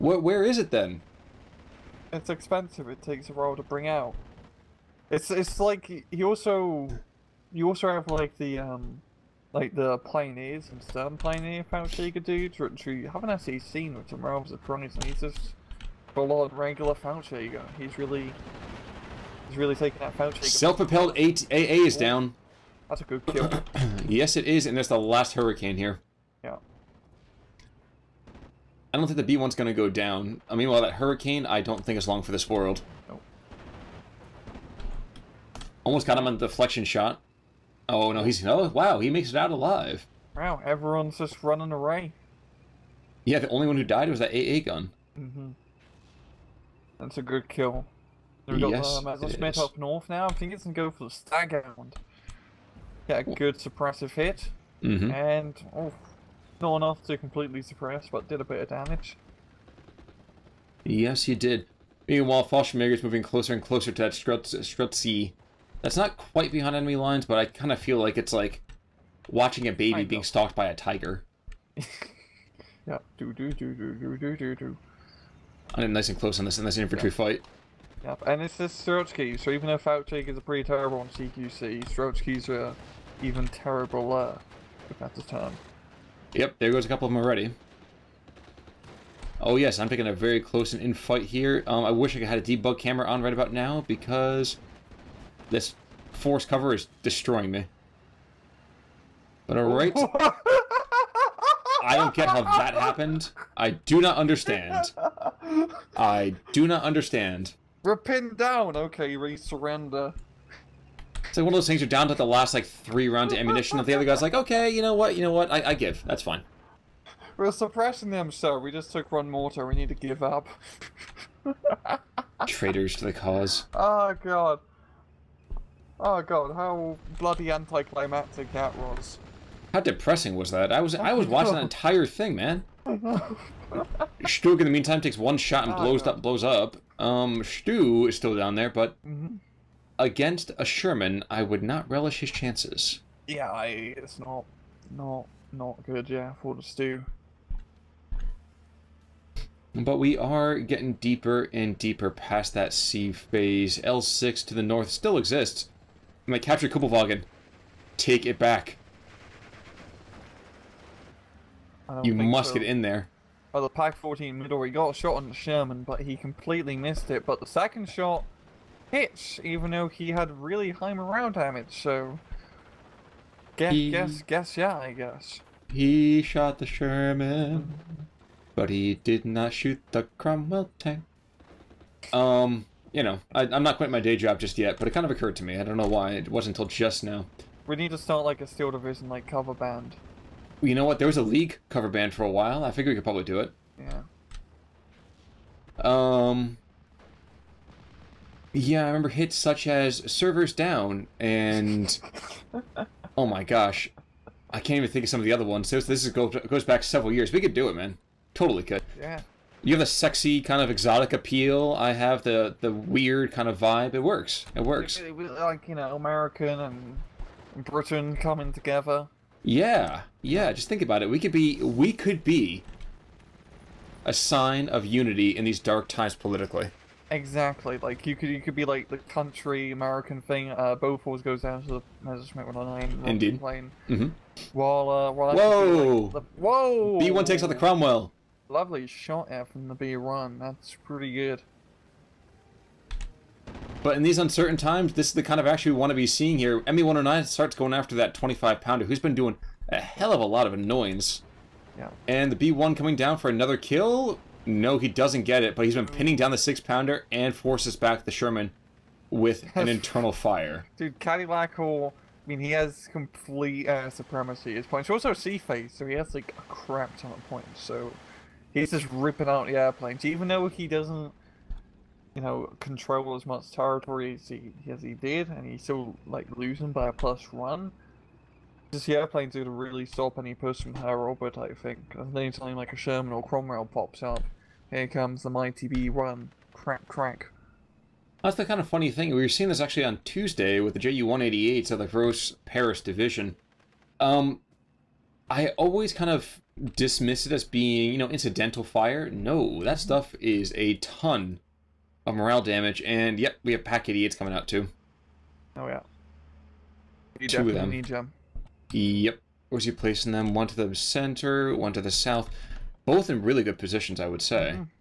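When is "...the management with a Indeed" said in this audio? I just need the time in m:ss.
3:51.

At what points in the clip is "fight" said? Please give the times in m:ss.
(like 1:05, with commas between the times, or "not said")
1:17, 1:30.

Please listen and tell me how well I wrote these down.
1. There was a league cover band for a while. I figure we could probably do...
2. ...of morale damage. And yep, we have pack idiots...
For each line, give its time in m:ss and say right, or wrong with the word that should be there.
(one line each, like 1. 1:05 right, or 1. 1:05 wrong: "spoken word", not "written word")
1. 3:10 right
2. 5:02 right.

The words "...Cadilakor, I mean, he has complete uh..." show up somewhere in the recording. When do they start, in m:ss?
4:20.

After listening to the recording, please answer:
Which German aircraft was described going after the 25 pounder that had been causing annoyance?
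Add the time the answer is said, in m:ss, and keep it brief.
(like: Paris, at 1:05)
Me 109, at 4:06.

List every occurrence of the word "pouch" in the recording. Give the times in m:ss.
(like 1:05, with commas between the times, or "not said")
0:11, 0:16.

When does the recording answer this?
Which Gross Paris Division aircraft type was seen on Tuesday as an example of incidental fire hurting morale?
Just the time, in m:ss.
4:50.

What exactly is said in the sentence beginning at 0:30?
I mean, while that hurricane, I don't think it's long for this world.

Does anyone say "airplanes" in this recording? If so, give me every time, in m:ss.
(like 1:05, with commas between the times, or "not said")
4:29, 4:38.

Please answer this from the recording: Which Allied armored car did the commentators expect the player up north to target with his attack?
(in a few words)
Stag hound.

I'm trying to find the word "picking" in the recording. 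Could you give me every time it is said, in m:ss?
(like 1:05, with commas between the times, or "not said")
1:29.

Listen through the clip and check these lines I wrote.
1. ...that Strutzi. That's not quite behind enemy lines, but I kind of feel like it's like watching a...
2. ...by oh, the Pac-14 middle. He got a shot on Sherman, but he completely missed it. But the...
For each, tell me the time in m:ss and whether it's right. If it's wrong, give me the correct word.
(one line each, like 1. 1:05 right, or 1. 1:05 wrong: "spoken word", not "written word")
1. 1:04 right
2. 2:43 right.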